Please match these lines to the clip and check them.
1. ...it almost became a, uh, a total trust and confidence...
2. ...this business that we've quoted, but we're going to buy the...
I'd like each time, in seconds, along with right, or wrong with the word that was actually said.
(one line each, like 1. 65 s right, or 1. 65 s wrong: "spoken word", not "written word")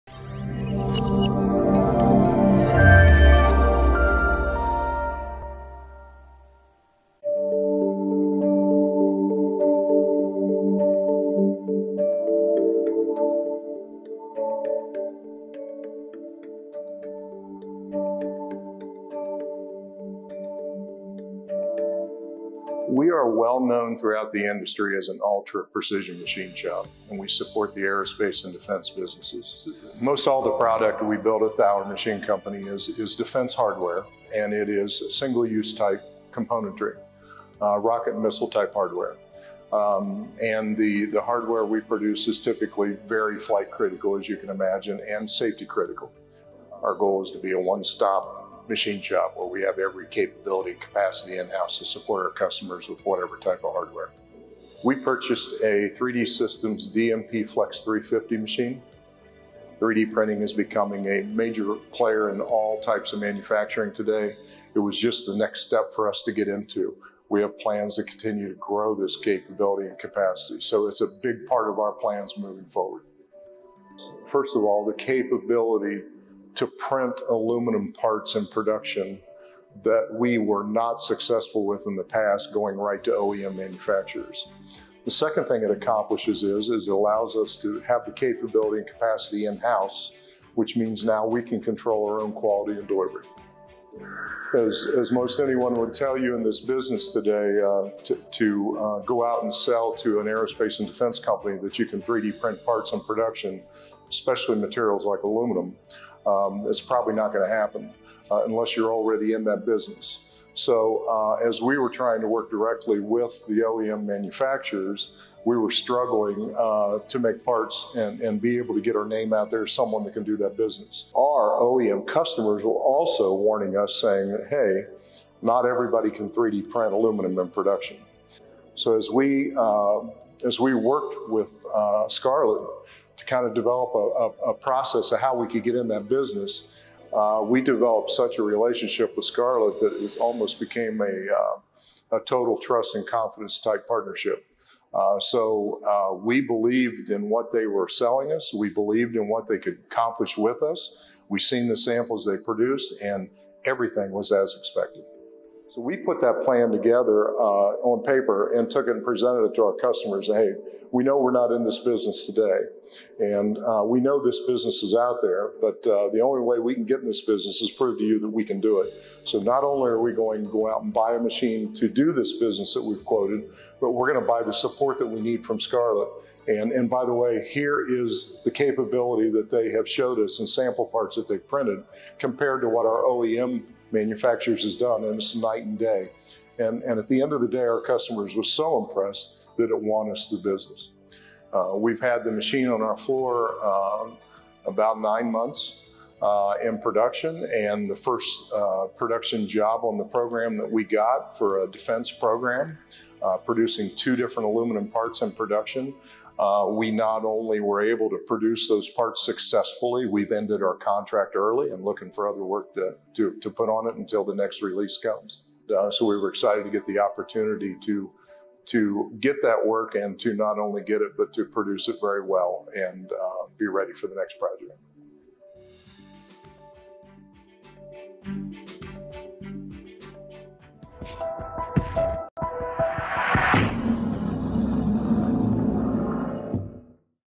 1. 140 s right
2. 172 s right.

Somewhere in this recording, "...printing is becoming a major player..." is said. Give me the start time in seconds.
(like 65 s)
60 s.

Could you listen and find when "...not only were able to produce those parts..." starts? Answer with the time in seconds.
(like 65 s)
206 s.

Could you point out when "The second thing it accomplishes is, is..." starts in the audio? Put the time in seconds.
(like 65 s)
85 s.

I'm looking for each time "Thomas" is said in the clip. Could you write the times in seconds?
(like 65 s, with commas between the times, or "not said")
not said.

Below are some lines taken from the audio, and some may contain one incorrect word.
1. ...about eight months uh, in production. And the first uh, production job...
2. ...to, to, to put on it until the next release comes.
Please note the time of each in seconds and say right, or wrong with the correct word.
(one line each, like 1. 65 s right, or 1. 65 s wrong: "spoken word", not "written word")
1. 194 s wrong: "nine", not "eight"
2. 212 s right.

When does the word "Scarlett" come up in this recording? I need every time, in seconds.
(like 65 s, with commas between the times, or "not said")
132 s, 139 s, 175 s.